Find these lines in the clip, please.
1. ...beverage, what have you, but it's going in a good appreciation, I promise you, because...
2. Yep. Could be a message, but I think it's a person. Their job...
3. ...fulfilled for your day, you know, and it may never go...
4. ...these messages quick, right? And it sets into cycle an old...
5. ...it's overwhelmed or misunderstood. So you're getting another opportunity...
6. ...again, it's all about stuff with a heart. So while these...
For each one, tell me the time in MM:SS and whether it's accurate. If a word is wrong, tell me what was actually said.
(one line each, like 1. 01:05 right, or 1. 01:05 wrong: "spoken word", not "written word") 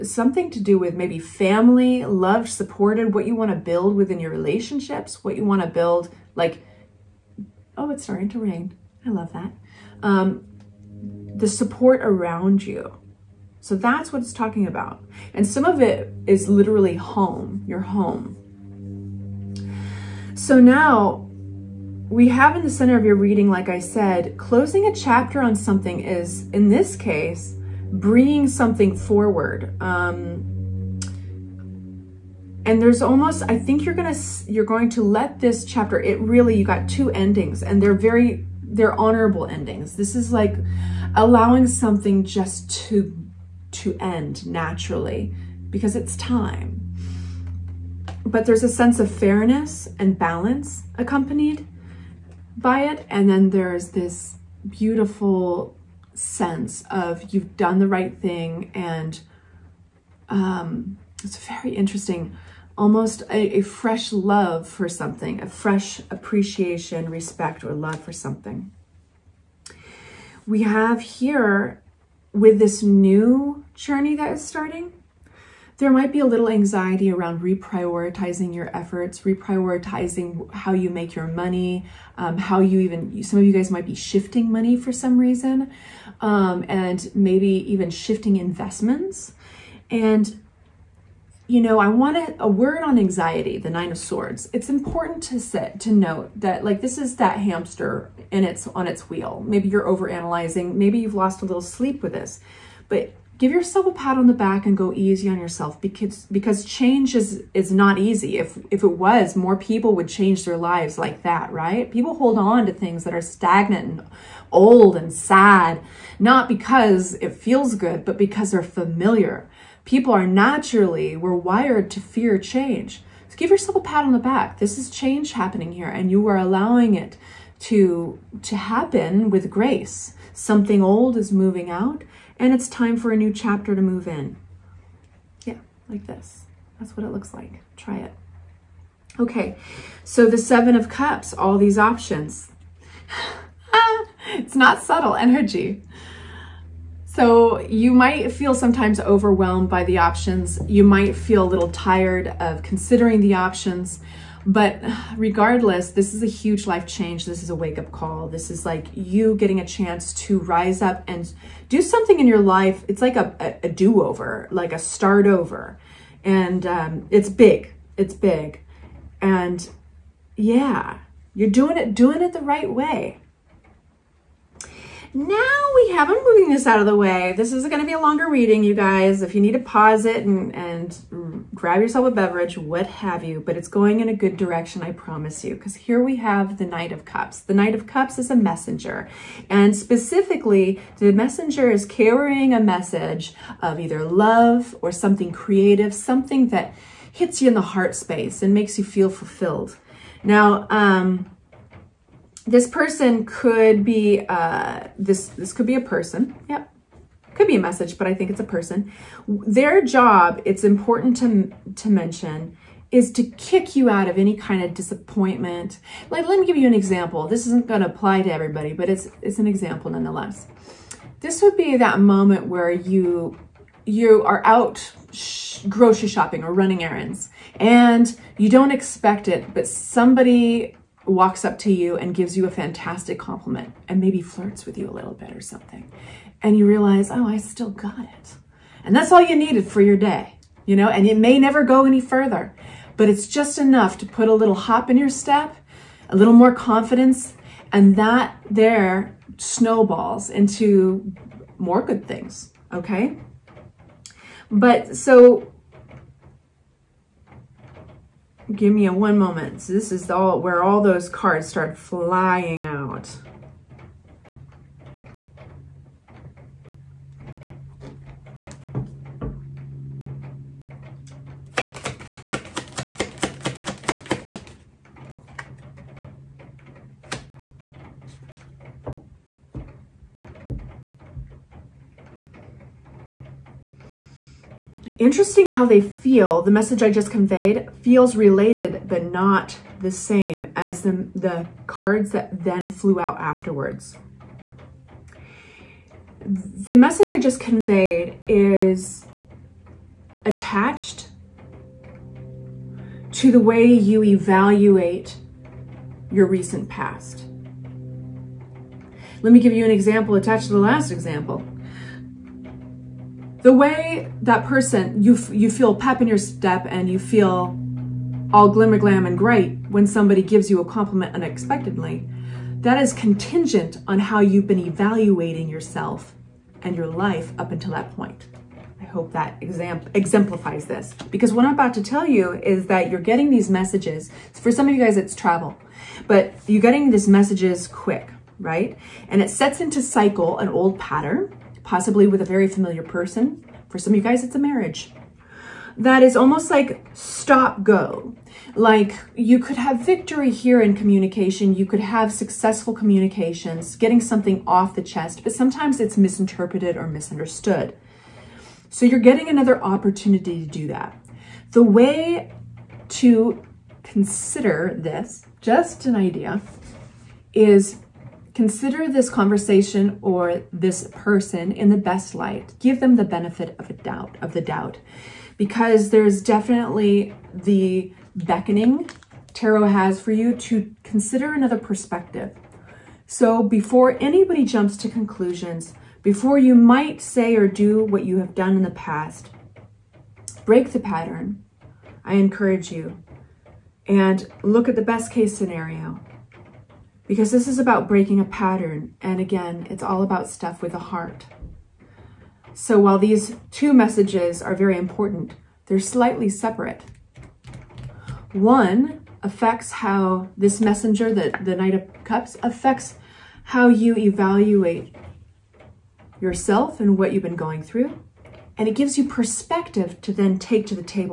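1. 03:02 wrong: "direction", not "appreciation"
2. 03:26 right
3. 03:59 wrong: "needed", not "fulfilled"
4. 05:36 right
5. 05:55 wrong: "misinterpreted", not "overwhelmed"
6. 06:39 right.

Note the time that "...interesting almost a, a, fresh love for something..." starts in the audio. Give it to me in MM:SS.
01:01.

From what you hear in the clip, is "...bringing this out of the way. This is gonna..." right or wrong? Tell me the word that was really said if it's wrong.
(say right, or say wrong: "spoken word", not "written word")
wrong: "moving", not "bringing".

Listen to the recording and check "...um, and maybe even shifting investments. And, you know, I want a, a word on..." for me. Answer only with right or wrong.
right.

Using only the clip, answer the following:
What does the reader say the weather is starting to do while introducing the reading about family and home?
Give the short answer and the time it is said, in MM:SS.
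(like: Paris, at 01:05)
Rain, at 00:08.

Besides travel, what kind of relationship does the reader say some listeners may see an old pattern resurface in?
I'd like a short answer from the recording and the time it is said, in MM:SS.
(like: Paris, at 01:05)
A marriage, at 05:44.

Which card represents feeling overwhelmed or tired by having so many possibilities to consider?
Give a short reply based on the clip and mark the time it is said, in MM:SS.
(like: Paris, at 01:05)
Seven of Cups, at 02:20.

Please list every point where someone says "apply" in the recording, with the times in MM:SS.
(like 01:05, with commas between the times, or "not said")
03:37.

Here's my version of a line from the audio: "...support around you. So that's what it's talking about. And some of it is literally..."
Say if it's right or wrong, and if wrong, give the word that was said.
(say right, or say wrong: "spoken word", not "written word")
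right.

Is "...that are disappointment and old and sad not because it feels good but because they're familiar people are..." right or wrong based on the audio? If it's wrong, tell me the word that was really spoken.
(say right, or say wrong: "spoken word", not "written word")
wrong: "stagnant", not "disappointment".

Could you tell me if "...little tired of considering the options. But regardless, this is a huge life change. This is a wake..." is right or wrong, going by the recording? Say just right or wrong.
right.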